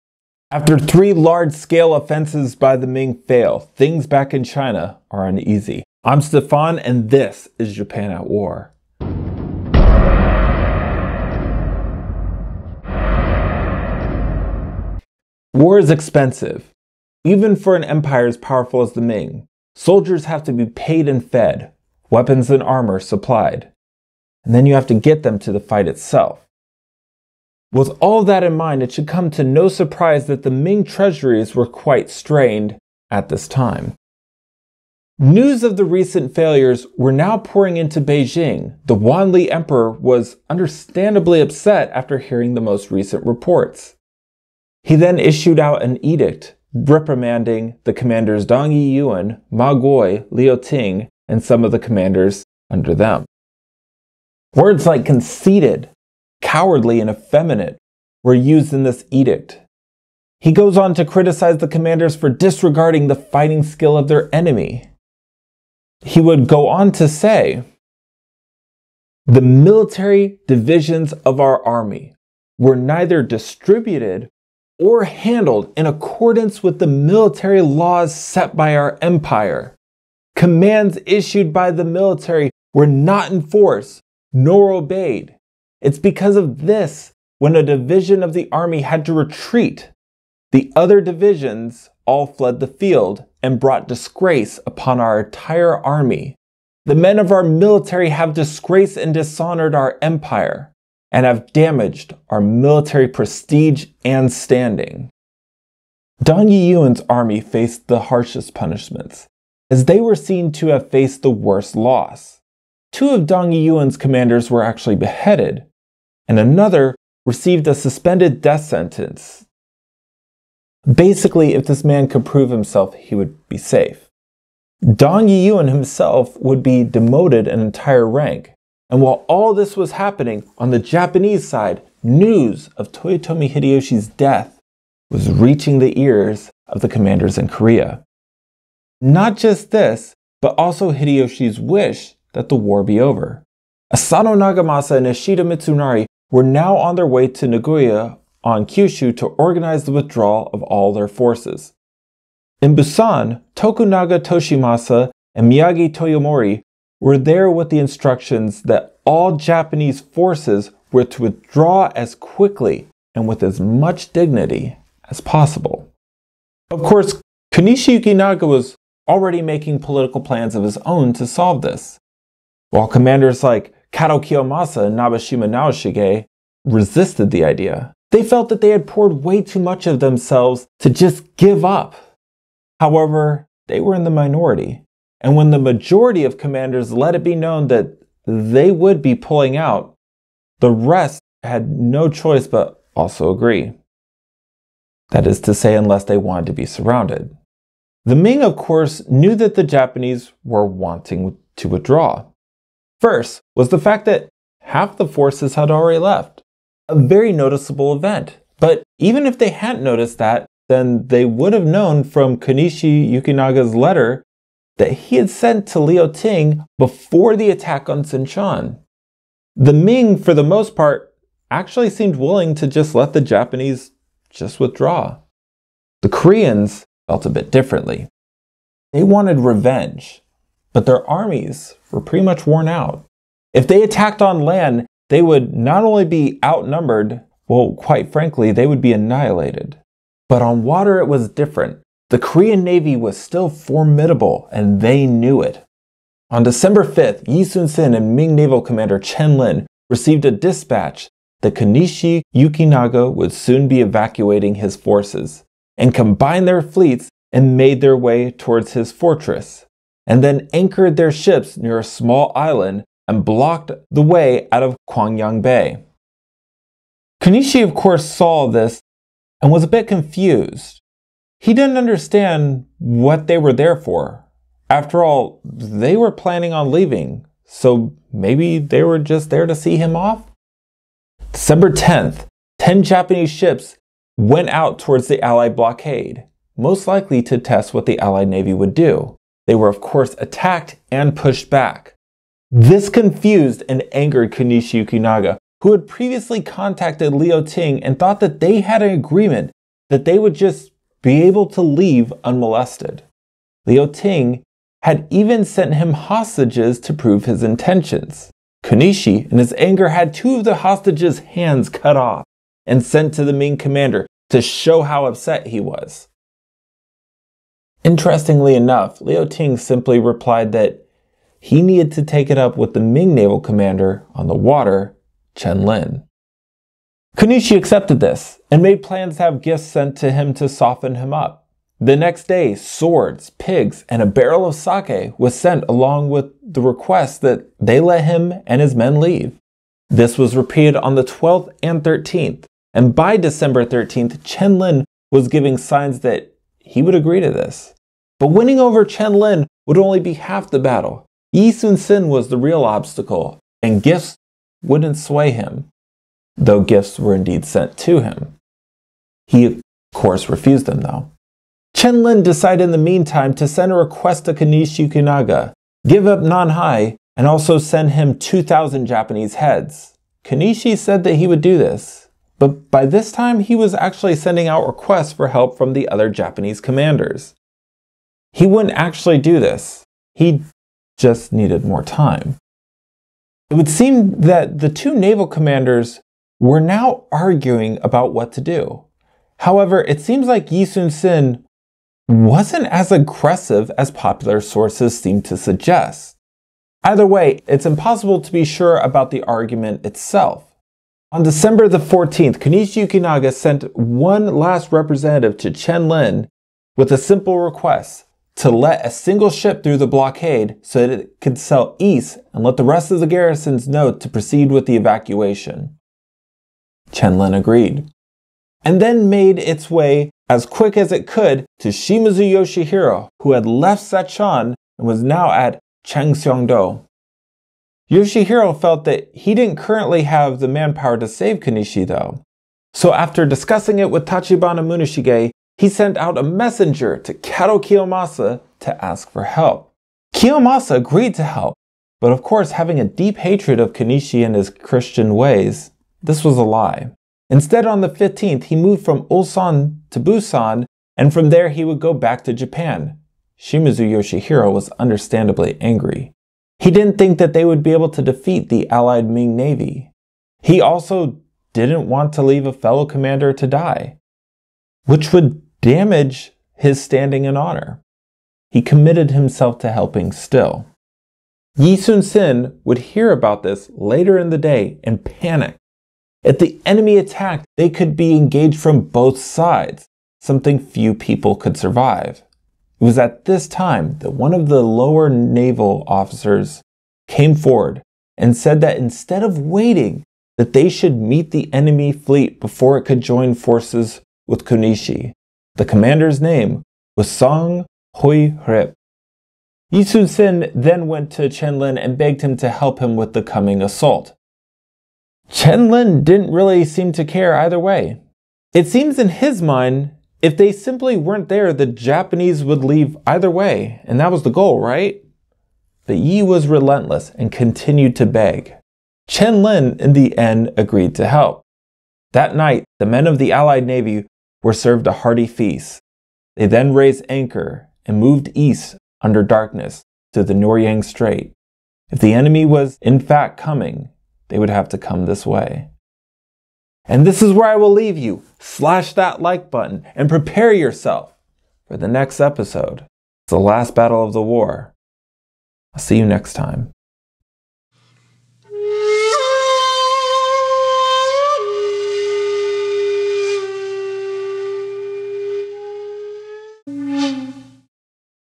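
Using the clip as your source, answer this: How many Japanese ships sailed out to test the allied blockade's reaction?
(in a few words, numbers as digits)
10.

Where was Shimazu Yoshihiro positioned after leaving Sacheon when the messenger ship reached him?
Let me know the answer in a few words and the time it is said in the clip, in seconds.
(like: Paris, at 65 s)
Changseongdo, at 425 s.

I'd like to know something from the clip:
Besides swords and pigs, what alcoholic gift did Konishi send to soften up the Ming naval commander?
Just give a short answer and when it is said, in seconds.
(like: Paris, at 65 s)
a barrel of sake, at 334 s.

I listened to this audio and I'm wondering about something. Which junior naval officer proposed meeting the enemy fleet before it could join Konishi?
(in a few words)
Song Hui Rip.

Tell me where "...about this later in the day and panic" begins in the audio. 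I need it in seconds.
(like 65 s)
473 s.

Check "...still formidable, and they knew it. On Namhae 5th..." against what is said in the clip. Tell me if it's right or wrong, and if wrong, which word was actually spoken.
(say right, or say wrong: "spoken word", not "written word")
wrong: "December", not "Namhae".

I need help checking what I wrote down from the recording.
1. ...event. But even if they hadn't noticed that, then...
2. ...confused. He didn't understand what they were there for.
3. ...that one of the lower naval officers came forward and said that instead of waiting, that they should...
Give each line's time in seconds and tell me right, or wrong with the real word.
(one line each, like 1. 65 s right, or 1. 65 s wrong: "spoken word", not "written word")
1. 207 s right
2. 269 s right
3. 483 s right.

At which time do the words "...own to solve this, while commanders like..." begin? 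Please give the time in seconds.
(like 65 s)
170 s.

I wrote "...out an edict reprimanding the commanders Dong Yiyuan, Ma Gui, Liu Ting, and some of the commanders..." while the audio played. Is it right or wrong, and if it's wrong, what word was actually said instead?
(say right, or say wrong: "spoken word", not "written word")
right.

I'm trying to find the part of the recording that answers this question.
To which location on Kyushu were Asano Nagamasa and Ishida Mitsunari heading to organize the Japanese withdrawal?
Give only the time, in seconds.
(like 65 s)
147 s.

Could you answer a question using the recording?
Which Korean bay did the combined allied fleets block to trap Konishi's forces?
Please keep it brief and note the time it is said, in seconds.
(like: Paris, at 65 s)
Kwangyang Bay, at 264 s.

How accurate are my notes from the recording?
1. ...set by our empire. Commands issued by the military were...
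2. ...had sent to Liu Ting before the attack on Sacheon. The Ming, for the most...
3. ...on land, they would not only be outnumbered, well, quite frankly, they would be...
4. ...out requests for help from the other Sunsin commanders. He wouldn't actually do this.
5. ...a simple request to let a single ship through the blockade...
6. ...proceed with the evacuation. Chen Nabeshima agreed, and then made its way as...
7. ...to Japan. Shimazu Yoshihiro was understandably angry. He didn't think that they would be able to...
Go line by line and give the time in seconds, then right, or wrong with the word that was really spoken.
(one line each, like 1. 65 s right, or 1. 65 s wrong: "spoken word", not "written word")
1. 78 s right
2. 215 s right
3. 234 s right
4. 374 s wrong: "Japanese", not "Sunsin"
5. 406 s right
6. 414 s wrong: "Lin", not "Nabeshima"
7. 452 s right.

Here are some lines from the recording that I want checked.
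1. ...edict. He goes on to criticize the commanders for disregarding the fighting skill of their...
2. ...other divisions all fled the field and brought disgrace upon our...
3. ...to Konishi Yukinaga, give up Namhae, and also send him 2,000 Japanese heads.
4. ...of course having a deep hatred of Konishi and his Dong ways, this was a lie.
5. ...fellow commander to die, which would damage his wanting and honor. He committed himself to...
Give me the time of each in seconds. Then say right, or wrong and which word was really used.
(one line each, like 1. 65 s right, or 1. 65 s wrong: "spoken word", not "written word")
1. 59 s right
2. 90 s right
3. 364 s right
4. 442 s wrong: "Christian", not "Dong"
5. 462 s wrong: "standing", not "wanting".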